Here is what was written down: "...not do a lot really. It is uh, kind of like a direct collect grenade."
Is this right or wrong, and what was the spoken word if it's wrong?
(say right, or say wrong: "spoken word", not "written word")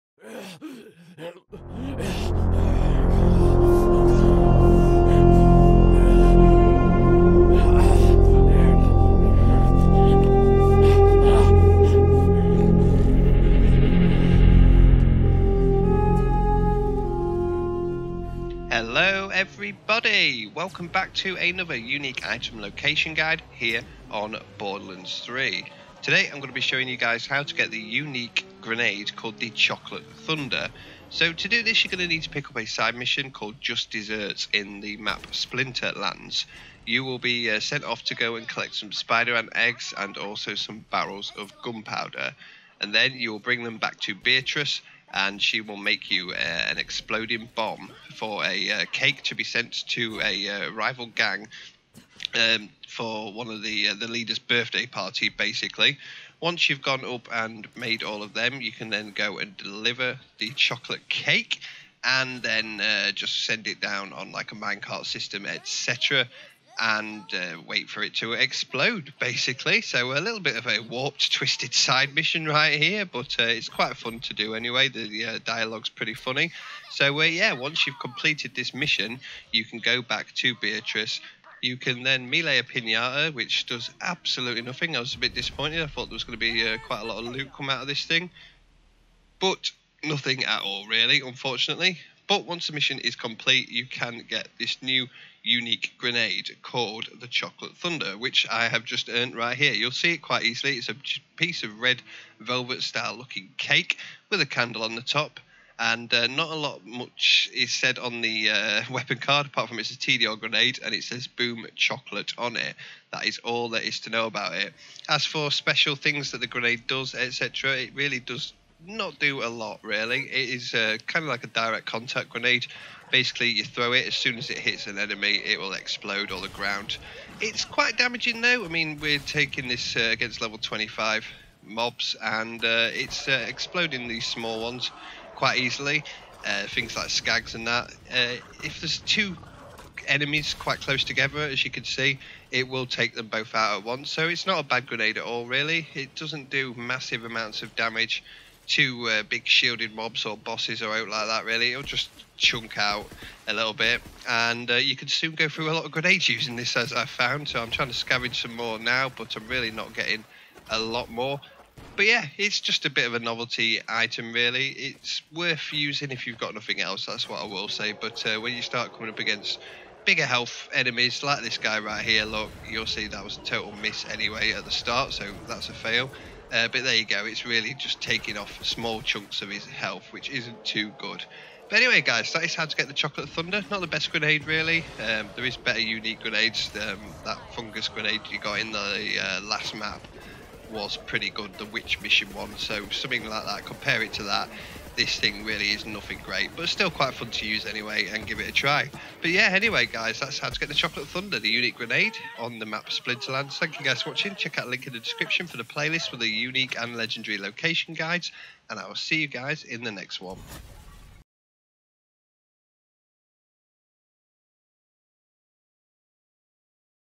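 wrong: "contact", not "collect".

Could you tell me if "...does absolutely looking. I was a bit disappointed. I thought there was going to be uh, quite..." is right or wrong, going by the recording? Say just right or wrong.
wrong.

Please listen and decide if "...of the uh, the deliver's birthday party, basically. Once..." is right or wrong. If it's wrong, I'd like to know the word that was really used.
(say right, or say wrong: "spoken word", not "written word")
wrong: "leader", not "deliver".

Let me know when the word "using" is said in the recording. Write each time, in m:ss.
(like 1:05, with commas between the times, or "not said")
2:36, 2:45.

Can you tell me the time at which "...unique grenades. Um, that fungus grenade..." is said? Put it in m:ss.
3:05.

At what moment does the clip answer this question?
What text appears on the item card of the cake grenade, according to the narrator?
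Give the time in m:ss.
1:51.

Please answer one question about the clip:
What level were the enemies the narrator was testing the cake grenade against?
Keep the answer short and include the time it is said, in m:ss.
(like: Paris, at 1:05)
25, at 2:10.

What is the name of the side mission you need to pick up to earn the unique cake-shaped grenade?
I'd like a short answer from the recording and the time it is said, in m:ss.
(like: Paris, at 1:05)
Just Desserts, at 0:33.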